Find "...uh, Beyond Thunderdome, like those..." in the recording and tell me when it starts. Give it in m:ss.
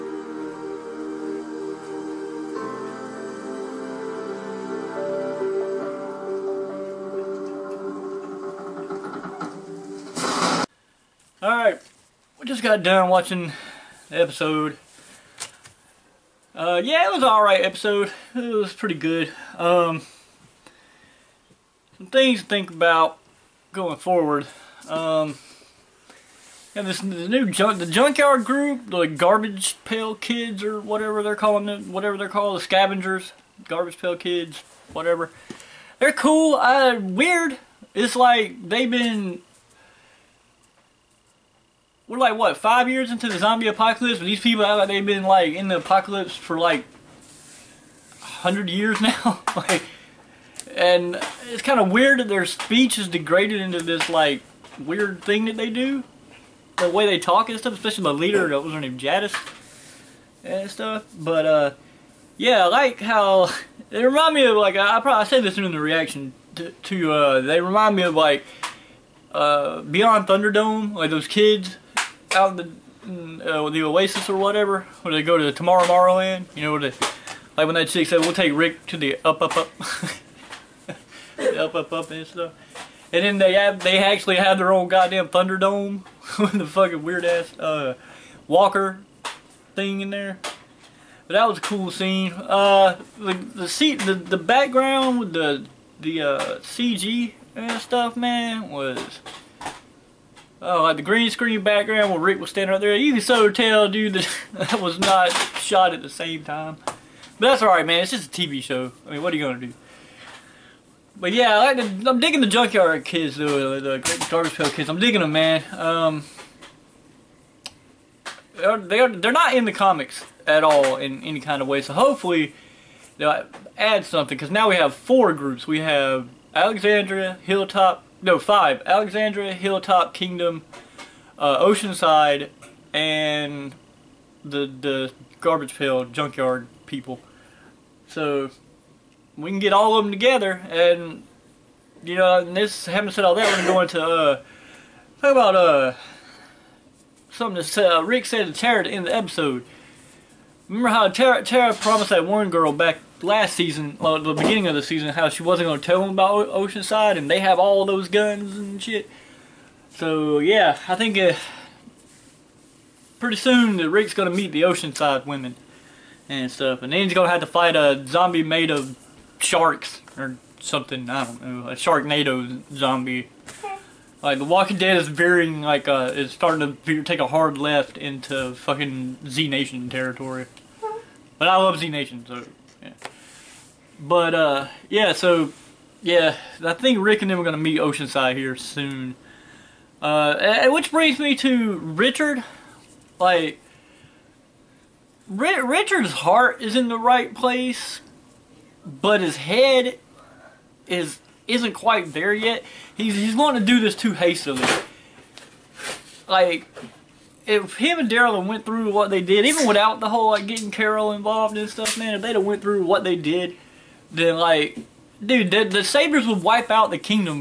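1:09.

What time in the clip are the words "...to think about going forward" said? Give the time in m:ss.
0:22.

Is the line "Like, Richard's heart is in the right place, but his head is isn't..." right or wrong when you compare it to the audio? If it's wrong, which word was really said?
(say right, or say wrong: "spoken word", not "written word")
right.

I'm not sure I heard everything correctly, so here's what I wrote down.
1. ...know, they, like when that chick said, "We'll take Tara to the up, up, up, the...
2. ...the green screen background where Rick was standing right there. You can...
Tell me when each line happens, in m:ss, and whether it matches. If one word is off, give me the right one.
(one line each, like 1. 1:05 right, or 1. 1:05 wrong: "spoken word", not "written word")
1. 1:16 wrong: "Rick", not "Tara"
2. 1:40 right.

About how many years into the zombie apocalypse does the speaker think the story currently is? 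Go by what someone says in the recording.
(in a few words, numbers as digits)
5.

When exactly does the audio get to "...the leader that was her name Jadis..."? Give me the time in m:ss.
0:58.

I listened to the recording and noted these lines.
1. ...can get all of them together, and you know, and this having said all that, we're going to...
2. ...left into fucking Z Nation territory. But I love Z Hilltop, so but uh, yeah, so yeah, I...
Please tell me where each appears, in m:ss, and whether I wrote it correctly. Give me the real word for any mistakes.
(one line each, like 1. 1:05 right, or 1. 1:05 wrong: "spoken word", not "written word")
1. 2:19 right
2. 2:57 wrong: "Nation", not "Hilltop".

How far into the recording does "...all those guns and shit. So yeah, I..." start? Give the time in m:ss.
2:37.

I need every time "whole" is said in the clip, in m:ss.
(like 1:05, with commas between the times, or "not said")
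3:30.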